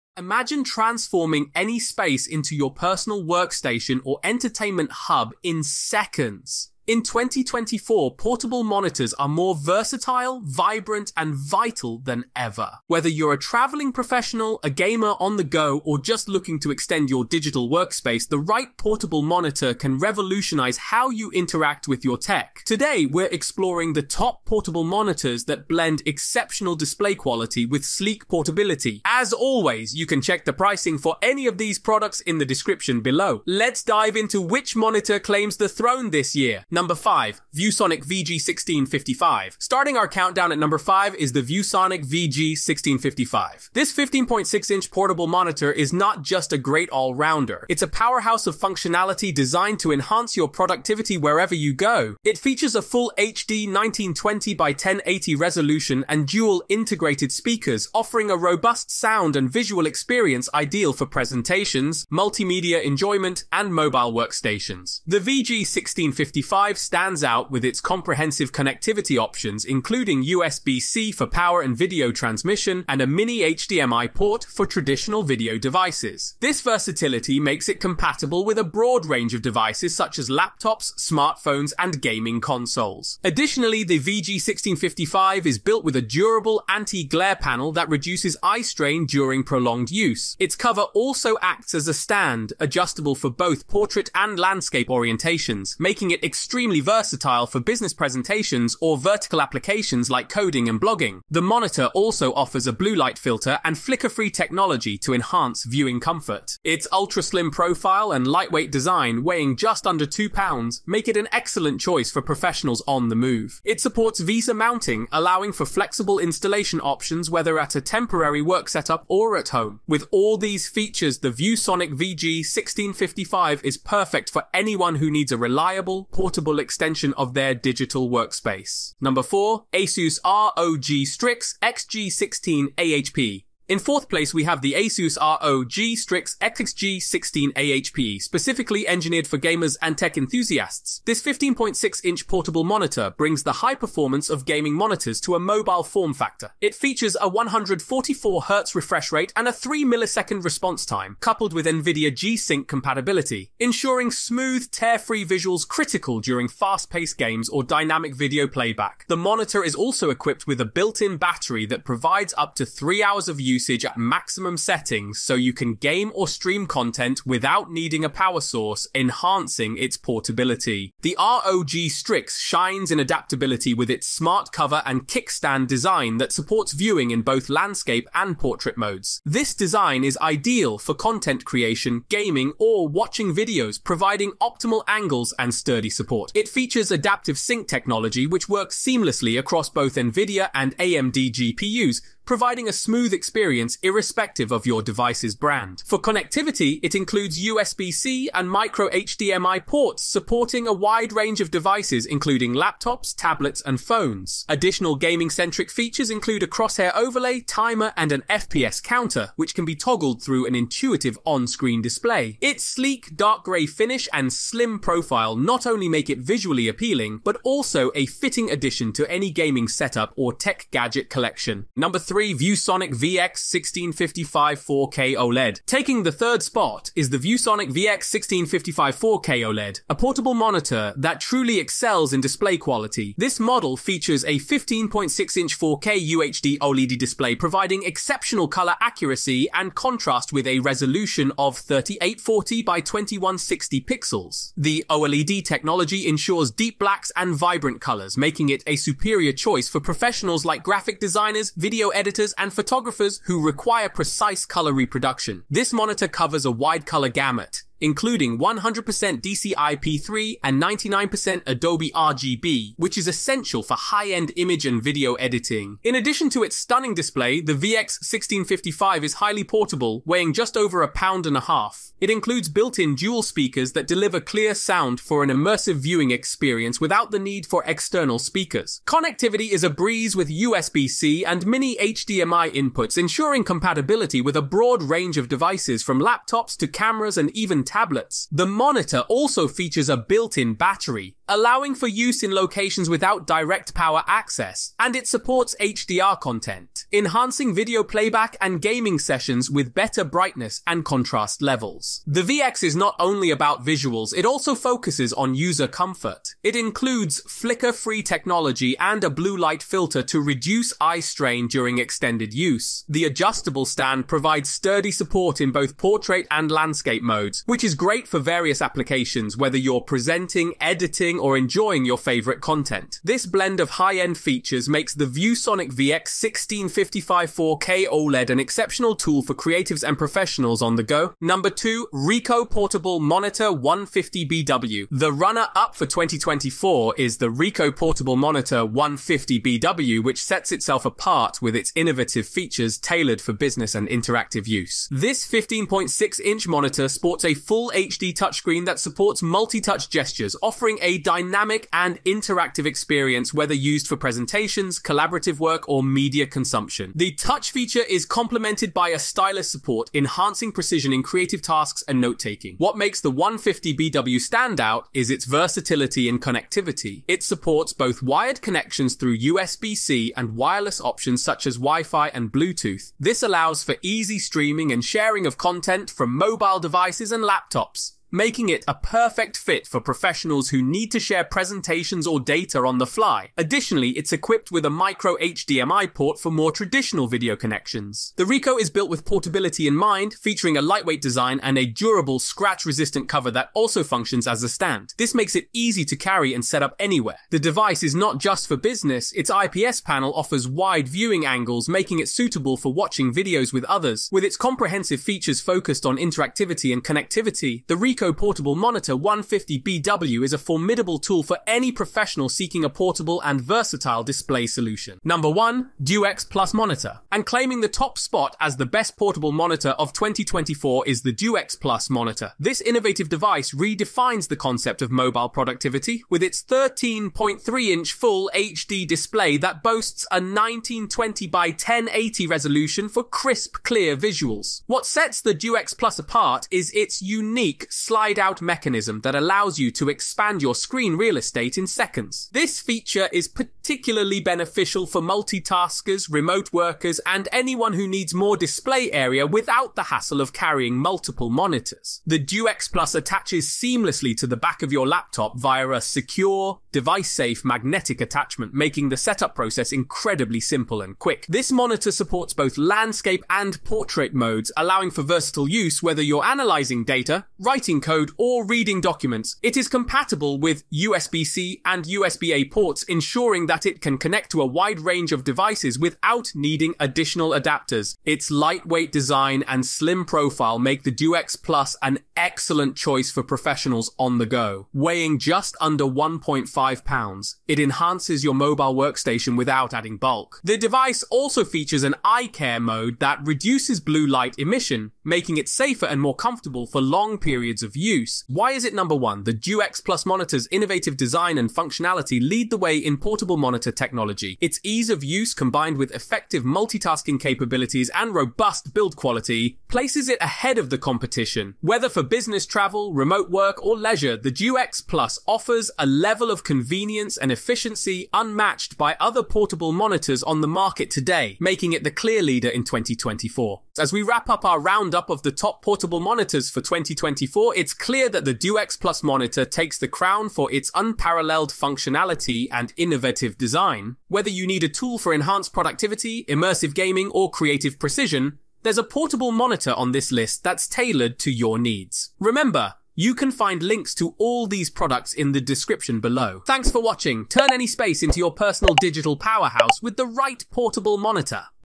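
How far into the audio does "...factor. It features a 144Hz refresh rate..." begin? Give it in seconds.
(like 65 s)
146 s.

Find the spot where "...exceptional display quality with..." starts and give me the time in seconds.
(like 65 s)
26 s.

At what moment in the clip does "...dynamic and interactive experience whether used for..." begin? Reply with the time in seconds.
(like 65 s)
351 s.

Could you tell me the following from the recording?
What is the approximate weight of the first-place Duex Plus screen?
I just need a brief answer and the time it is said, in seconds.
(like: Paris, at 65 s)
Just under 1.5 pounds, at 485 s.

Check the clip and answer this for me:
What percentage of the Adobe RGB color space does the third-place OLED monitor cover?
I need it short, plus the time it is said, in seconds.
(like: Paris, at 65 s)
99%, at 260 s.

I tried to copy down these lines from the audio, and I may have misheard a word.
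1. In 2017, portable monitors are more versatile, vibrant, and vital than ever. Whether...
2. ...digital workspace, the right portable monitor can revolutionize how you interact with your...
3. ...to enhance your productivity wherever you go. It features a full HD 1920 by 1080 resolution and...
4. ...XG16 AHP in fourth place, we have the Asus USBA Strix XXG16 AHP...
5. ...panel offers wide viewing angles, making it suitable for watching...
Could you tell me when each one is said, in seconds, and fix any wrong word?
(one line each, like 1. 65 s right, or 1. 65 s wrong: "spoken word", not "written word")
1. 6 s wrong: "2024", not "2017"
2. 17 s right
3. 49 s right
4. 131 s wrong: "ROG", not "USBA"
5. 399 s right.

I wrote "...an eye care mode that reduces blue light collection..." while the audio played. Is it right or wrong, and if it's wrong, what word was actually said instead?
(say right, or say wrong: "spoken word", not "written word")
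wrong: "emission", not "collection".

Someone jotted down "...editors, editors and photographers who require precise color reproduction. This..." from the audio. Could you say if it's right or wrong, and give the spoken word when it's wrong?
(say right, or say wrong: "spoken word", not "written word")
right.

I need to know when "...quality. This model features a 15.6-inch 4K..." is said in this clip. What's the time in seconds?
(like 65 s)
232 s.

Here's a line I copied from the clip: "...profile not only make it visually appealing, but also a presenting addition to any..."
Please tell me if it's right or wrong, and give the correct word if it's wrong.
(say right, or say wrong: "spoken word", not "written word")
wrong: "fitting", not "presenting".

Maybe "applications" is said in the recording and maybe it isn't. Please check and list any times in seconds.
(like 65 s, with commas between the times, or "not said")
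99 s, 318 s.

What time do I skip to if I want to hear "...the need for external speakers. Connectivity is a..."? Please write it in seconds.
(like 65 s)
277 s.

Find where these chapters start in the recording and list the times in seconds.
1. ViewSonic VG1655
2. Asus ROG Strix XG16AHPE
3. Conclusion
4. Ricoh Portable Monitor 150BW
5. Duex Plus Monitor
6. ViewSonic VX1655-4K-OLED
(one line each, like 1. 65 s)
1. 36 s
2. 129 s
3. 523 s
4. 330 s
5. 415 s
6. 221 s.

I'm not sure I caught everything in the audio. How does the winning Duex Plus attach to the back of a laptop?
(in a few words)
Magnetic attachment.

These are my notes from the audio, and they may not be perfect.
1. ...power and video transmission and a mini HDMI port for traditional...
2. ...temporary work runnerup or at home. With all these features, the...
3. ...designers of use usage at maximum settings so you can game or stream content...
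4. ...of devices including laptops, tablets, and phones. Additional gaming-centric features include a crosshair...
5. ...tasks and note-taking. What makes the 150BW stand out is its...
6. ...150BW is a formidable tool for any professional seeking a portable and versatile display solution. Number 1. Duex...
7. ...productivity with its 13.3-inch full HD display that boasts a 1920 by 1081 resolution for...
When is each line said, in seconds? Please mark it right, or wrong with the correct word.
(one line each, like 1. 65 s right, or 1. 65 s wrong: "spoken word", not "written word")
1. 71 s right
2. 117 s wrong: "setup", not "runnerup"
3. 163 s wrong: "hours", not "designers"
4. 201 s right
5. 361 s right
6. 408 s right
7. 425 s wrong: "1080", not "1081".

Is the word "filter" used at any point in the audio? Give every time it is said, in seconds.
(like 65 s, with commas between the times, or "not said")
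103 s, 309 s.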